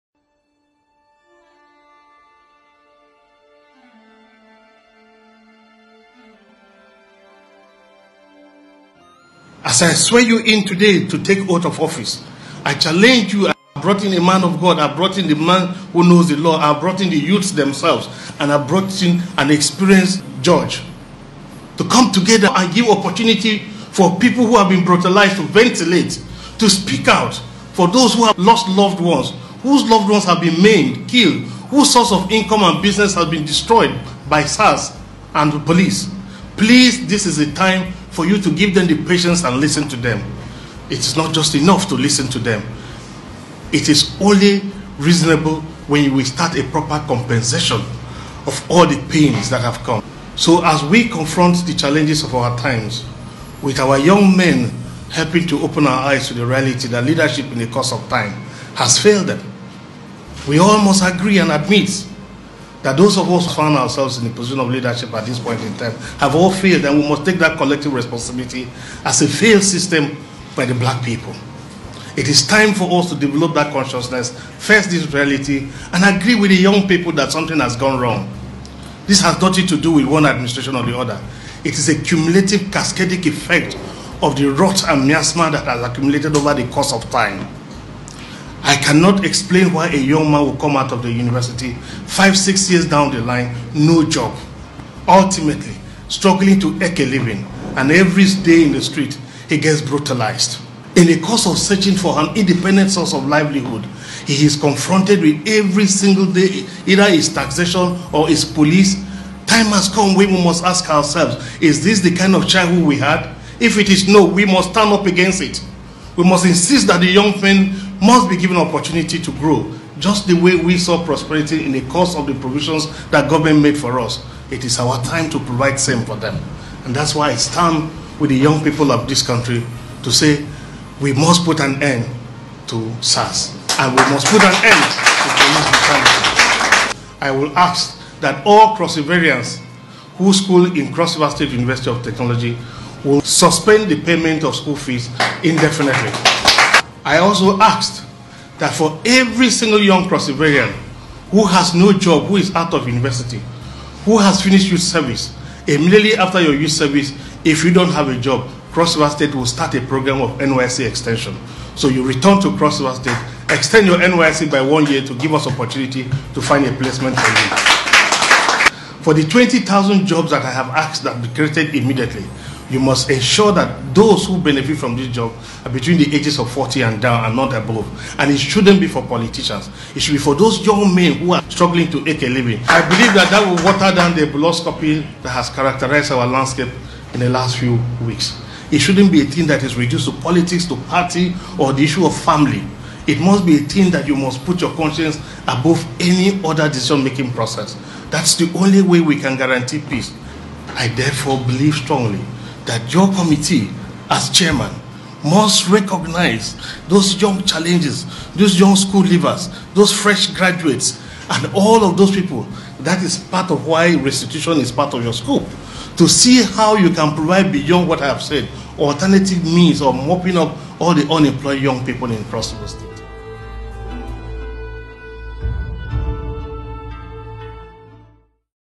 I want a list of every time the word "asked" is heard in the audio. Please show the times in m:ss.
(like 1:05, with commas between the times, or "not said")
2:27, 2:50.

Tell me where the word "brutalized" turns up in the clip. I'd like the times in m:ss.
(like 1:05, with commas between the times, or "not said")
0:24, 1:39.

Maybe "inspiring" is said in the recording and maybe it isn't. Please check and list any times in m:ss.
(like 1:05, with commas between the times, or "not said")
not said.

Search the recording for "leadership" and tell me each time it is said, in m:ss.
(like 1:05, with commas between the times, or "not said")
0:57, 1:04.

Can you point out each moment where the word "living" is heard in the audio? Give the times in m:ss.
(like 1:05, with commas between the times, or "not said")
1:37, 3:02.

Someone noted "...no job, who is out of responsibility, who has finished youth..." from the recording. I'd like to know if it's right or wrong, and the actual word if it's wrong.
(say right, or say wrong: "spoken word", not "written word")
wrong: "university", not "responsibility".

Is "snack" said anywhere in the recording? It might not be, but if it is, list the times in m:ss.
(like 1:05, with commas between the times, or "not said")
not said.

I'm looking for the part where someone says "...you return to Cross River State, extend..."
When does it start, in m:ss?
2:41.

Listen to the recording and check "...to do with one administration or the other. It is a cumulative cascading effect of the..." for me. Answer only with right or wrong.
right.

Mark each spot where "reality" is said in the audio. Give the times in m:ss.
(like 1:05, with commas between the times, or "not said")
0:56, 1:15.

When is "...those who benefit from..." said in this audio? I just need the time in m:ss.
2:53.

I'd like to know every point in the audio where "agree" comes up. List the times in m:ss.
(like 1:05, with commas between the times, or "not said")
1:01, 1:16.